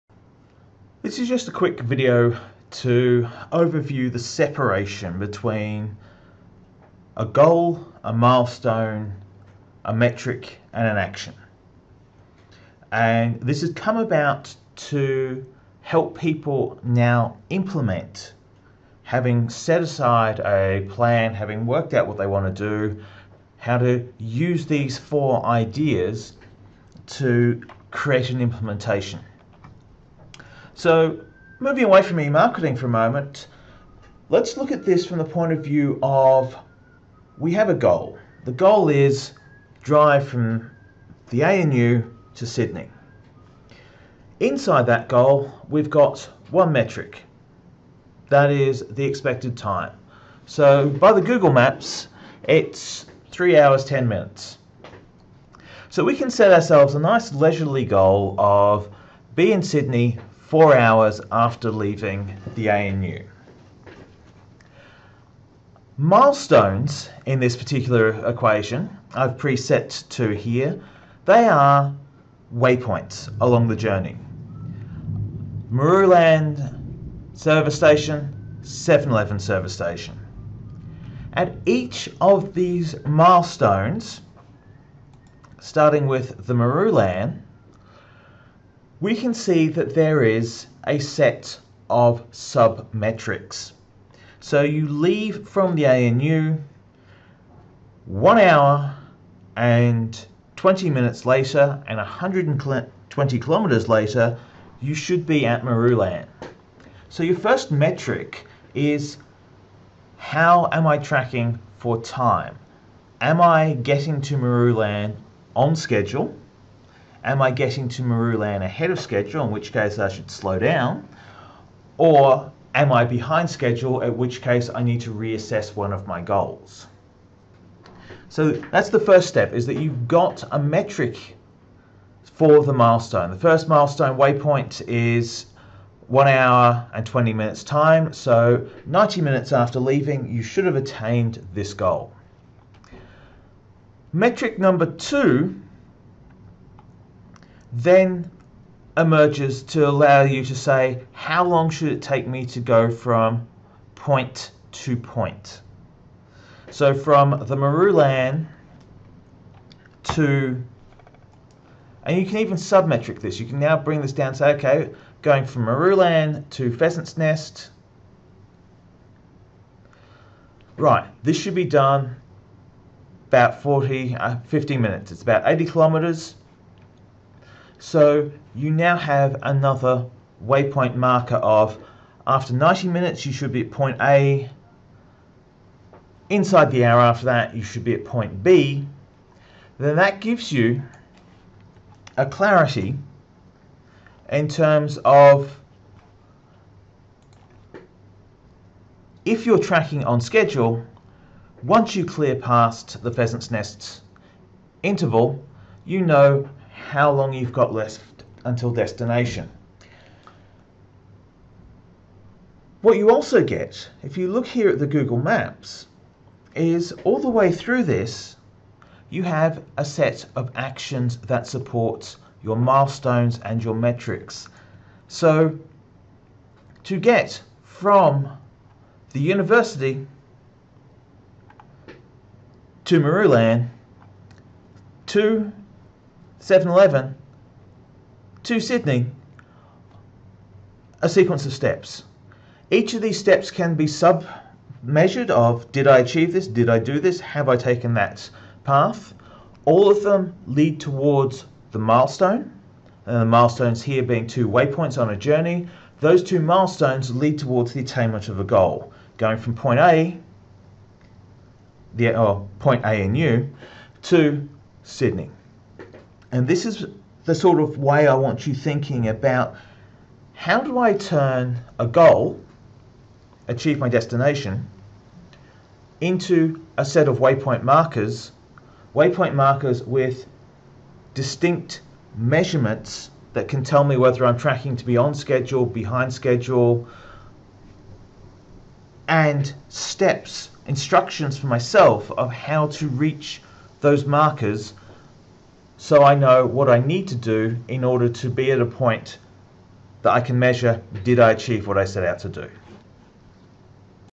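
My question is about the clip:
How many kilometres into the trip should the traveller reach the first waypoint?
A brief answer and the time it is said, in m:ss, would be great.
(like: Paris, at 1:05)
120 kilometres, at 1:41.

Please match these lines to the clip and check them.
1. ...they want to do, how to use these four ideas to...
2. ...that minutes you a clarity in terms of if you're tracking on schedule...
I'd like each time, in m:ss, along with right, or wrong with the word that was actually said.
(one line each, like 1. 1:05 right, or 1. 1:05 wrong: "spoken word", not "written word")
1. 0:22 right
2. 3:09 wrong: "gives", not "minutes".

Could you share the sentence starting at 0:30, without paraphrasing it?
So moving away from e-marketing for a moment, let's look at this from the point of view of we have a goal.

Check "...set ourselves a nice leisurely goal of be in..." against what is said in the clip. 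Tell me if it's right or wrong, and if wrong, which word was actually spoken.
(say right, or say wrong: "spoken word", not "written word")
right.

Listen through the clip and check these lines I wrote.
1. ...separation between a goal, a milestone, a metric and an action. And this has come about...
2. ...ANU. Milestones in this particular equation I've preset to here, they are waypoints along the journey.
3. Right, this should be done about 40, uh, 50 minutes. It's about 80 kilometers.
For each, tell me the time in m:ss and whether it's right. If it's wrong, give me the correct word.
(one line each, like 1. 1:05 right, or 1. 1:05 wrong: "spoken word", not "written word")
1. 0:04 right
2. 1:02 right
3. 2:50 right.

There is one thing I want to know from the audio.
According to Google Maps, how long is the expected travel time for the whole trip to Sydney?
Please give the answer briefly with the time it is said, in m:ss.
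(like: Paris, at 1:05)
3 hours 10 minutes, at 0:53.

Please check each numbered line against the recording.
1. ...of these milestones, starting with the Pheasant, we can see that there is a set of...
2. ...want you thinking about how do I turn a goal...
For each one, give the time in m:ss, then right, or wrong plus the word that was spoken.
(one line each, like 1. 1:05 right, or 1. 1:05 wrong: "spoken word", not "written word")
1. 1:22 wrong: "Marulan", not "Pheasant"
2. 4:28 right.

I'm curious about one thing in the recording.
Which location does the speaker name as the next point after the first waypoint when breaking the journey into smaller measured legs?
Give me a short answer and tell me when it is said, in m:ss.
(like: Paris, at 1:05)
Pheasant's Nest, at 2:46.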